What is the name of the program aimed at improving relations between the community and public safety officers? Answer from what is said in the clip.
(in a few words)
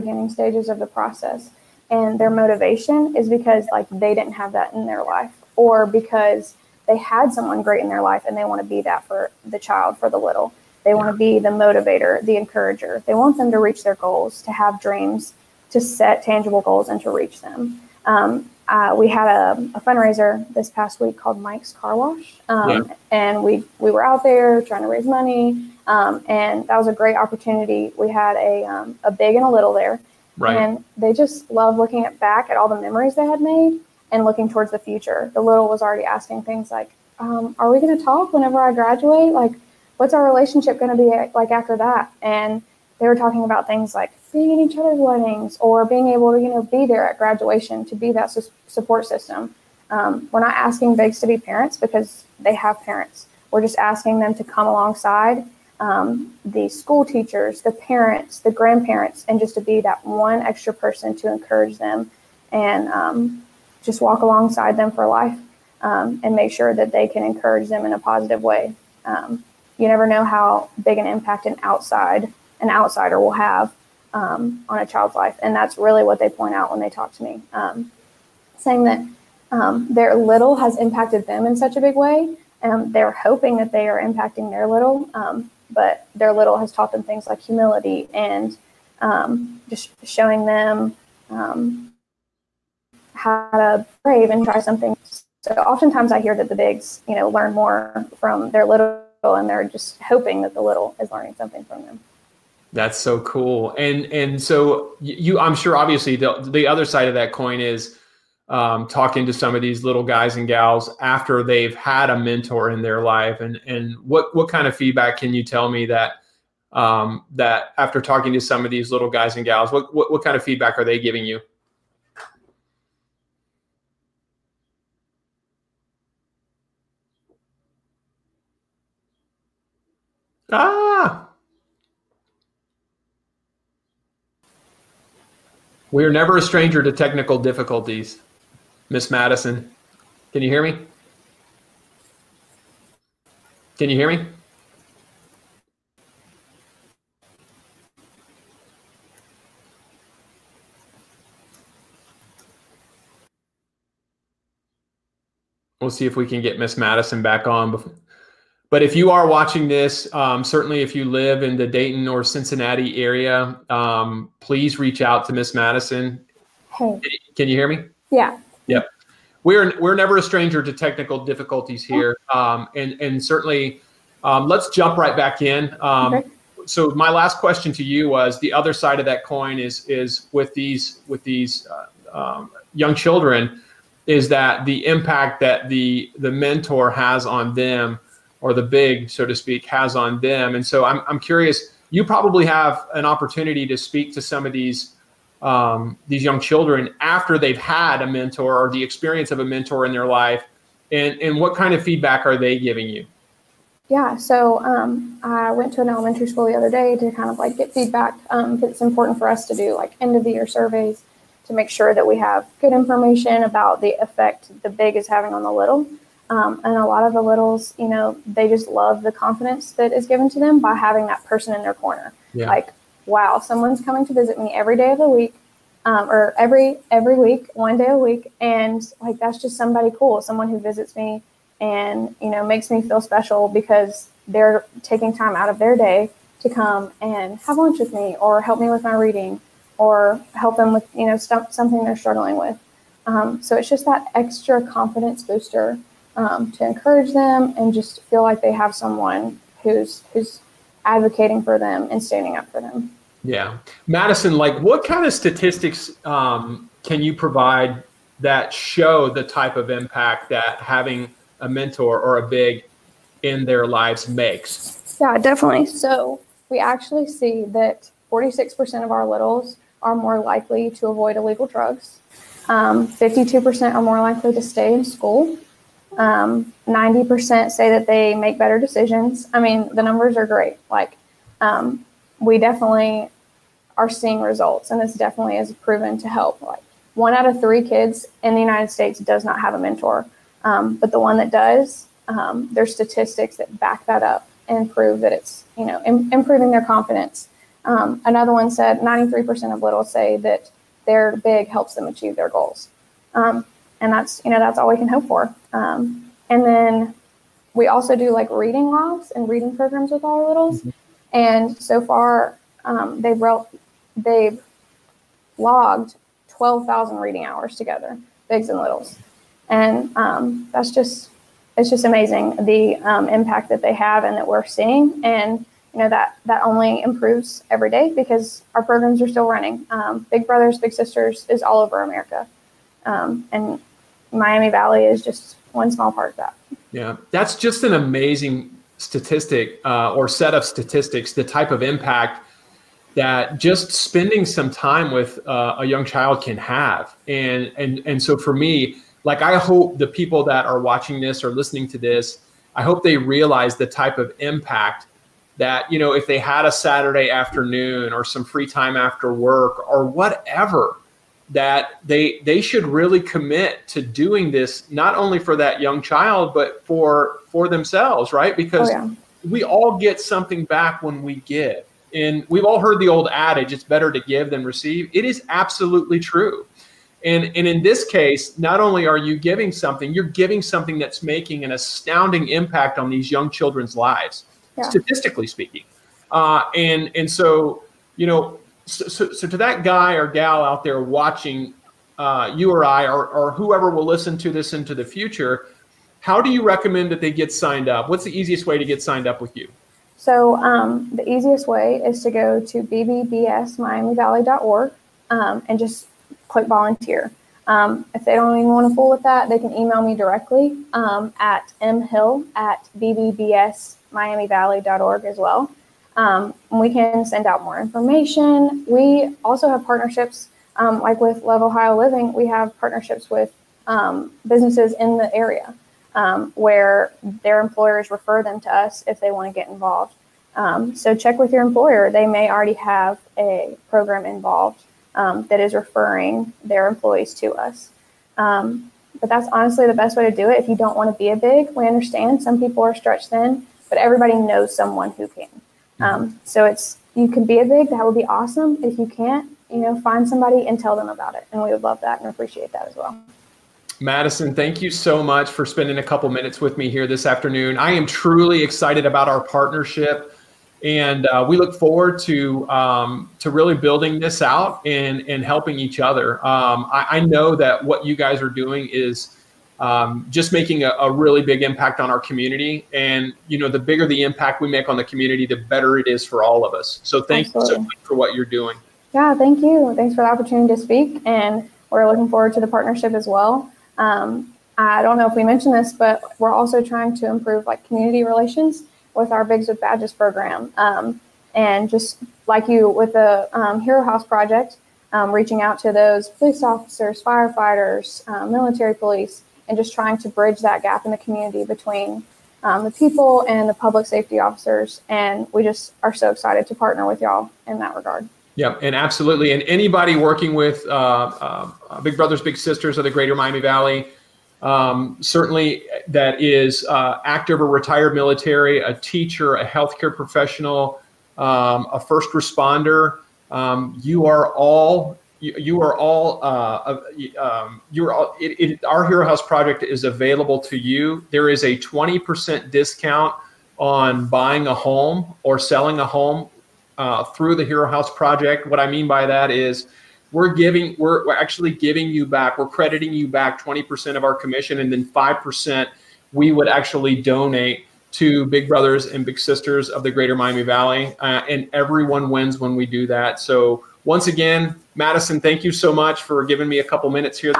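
Bigs with Badges.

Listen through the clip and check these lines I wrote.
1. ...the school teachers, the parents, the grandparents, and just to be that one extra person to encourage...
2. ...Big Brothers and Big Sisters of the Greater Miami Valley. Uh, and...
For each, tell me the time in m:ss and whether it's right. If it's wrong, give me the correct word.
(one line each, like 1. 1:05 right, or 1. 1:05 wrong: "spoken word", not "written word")
1. 0:56 right
2. 9:08 right.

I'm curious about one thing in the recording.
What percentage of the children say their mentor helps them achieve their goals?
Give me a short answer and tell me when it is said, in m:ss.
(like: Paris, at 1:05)
93%, at 4:58.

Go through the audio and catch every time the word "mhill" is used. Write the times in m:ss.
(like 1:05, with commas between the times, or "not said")
6:51.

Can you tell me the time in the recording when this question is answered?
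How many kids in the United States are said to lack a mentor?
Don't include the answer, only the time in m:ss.
4:46.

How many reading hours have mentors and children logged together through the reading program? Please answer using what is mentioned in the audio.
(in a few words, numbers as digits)
12,000.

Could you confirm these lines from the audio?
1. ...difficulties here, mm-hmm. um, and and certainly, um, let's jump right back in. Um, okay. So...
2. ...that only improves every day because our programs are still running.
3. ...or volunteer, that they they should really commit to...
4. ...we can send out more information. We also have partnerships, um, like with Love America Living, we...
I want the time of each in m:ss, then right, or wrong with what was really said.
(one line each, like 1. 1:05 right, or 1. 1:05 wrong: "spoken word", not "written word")
1. 2:51 right
2. 5:26 right
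3. 5:59 wrong: "whatever", not "volunteer"
4. 6:56 wrong: "Ohio", not "America".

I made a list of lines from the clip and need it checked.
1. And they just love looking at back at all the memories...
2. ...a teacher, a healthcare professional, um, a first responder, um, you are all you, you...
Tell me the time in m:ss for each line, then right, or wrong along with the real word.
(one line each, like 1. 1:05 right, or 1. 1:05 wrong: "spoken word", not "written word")
1. 0:30 right
2. 8:38 right.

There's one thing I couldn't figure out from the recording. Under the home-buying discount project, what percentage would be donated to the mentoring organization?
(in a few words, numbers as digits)
5%.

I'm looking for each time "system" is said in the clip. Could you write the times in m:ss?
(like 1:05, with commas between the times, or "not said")
0:49.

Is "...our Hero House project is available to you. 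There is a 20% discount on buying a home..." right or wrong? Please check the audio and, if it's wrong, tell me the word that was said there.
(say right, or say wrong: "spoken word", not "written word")
right.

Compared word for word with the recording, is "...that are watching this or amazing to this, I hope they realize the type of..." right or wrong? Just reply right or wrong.
wrong.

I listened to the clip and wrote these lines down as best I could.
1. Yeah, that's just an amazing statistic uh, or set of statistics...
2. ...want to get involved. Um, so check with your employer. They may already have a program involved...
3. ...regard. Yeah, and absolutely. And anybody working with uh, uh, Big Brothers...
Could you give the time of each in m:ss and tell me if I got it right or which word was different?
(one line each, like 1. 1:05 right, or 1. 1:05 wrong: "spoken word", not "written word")
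1. 5:36 right
2. 7:09 right
3. 8:27 right.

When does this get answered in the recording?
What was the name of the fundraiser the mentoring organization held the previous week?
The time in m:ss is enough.
0:21.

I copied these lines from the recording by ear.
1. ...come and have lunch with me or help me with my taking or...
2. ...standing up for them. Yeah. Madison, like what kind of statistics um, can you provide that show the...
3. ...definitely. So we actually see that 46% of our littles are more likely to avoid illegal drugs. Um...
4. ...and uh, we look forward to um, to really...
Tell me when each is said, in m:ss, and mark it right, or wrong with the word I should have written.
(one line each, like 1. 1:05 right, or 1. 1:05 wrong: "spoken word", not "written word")
1. 3:56 wrong: "reading", not "taking"
2. 4:12 right
3. 4:25 right
4. 7:40 right.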